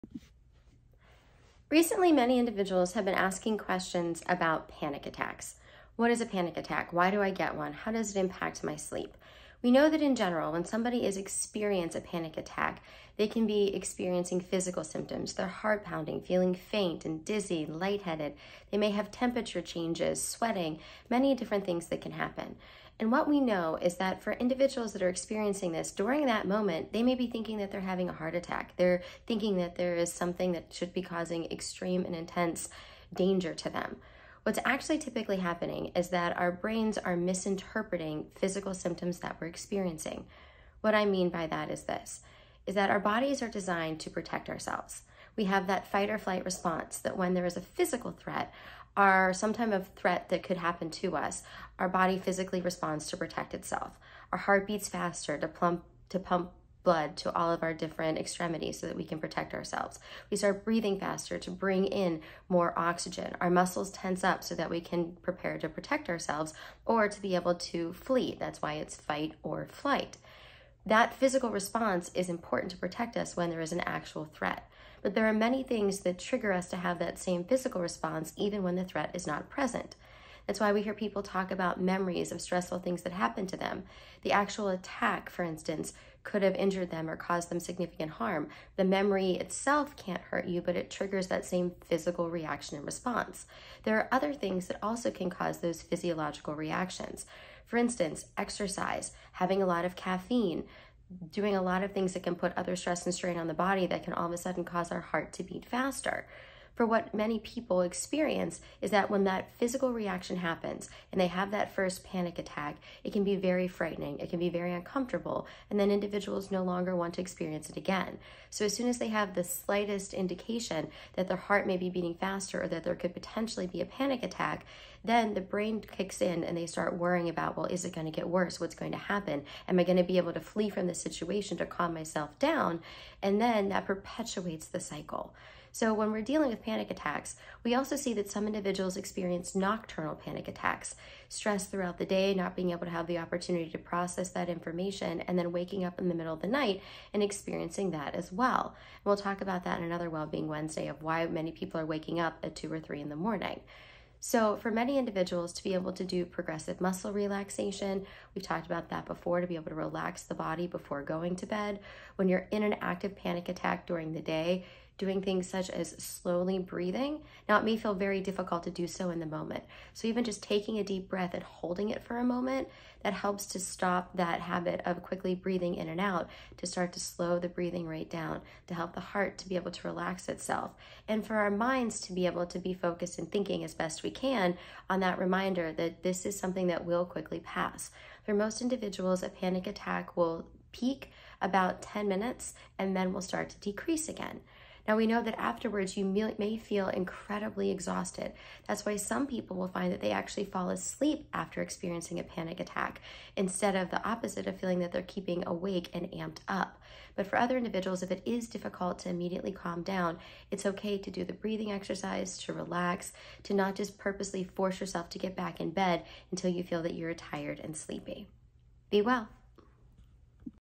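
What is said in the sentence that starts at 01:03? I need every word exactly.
Our muscles tense up so that we can prepare to protect ourselves or to be able to flee.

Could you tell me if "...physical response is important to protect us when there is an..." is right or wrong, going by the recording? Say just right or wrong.
right.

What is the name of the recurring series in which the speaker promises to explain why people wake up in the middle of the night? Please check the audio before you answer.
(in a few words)
Wellbeing Wednesday.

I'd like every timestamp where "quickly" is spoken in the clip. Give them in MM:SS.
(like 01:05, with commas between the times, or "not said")
02:55, 03:07.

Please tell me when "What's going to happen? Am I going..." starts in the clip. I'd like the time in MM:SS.
02:08.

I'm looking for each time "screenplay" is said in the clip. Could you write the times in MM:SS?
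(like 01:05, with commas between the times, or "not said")
not said.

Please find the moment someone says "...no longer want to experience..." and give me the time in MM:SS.
01:56.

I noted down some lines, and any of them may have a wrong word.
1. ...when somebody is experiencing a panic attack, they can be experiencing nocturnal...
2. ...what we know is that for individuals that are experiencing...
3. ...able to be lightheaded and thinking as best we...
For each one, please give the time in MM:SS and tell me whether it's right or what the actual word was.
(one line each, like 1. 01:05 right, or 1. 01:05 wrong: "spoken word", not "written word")
1. 00:10 wrong: "physical", not "nocturnal"
2. 00:23 right
3. 03:02 wrong: "focused", not "lightheaded".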